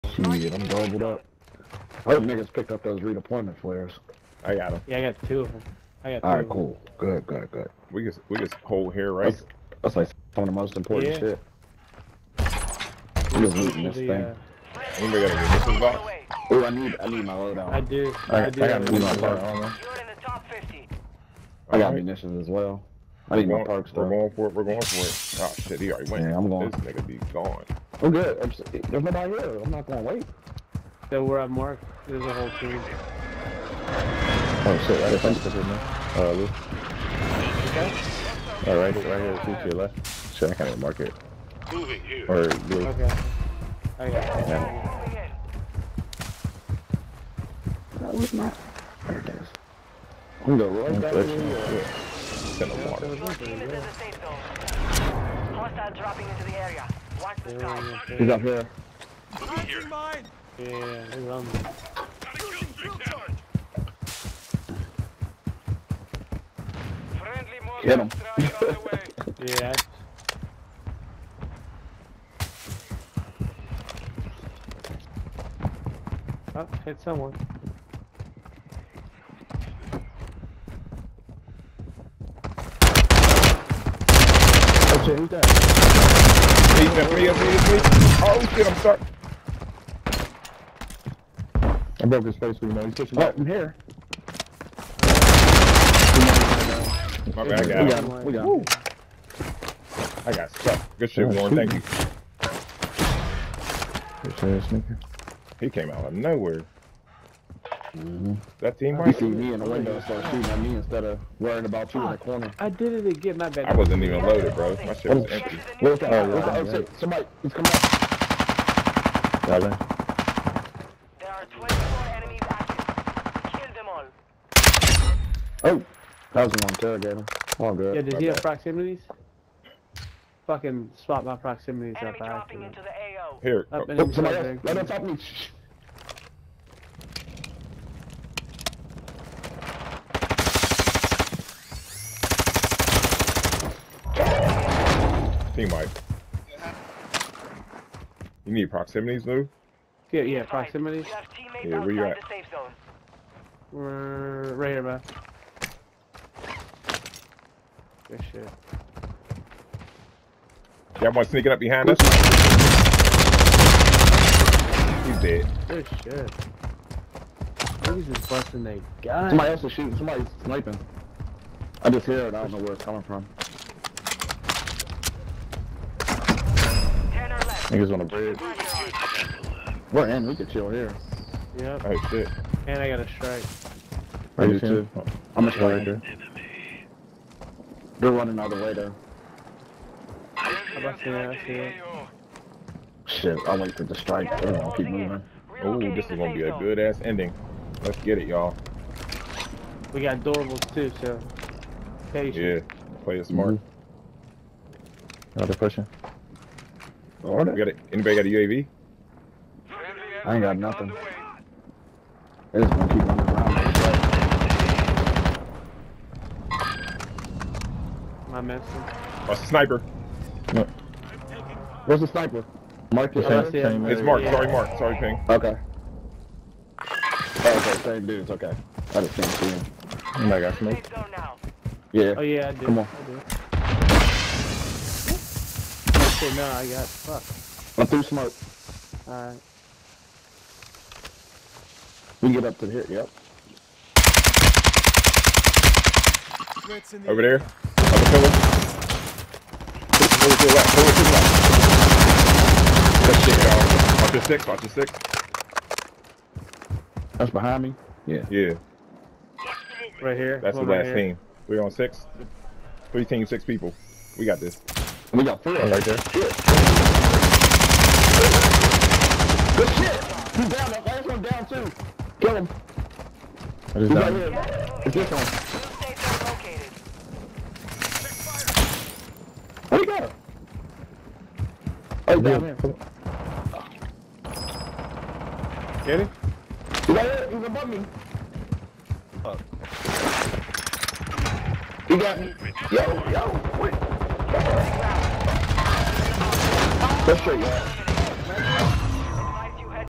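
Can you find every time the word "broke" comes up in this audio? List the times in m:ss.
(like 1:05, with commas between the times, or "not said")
1:32.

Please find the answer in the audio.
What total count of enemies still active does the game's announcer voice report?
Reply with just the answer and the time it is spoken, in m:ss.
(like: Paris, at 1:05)
24, at 2:01.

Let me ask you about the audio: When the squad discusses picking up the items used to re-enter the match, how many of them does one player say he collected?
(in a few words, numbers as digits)
2.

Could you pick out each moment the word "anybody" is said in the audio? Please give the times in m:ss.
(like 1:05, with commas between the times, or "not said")
0:14, 3:27.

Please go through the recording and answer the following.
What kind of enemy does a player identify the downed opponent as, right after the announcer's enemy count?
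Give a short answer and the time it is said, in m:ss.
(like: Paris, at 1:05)
Interrogator, at 2:06.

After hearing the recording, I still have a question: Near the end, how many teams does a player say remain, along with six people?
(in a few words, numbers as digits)
3.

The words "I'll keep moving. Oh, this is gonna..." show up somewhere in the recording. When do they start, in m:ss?
3:14.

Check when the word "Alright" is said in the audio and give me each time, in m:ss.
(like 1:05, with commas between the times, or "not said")
3:01, 3:59.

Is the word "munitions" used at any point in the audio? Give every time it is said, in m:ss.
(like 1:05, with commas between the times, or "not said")
0:21.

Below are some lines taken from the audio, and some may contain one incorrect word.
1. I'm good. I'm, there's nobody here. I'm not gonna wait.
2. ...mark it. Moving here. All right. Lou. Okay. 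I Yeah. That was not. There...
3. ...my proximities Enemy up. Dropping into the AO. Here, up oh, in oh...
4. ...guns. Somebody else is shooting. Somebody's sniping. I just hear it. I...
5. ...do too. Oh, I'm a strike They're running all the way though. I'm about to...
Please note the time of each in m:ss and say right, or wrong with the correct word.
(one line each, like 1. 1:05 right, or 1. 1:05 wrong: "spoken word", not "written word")
1. 0:28 right
2. 0:40 right
3. 2:11 right
4. 2:49 right
5. 3:04 right.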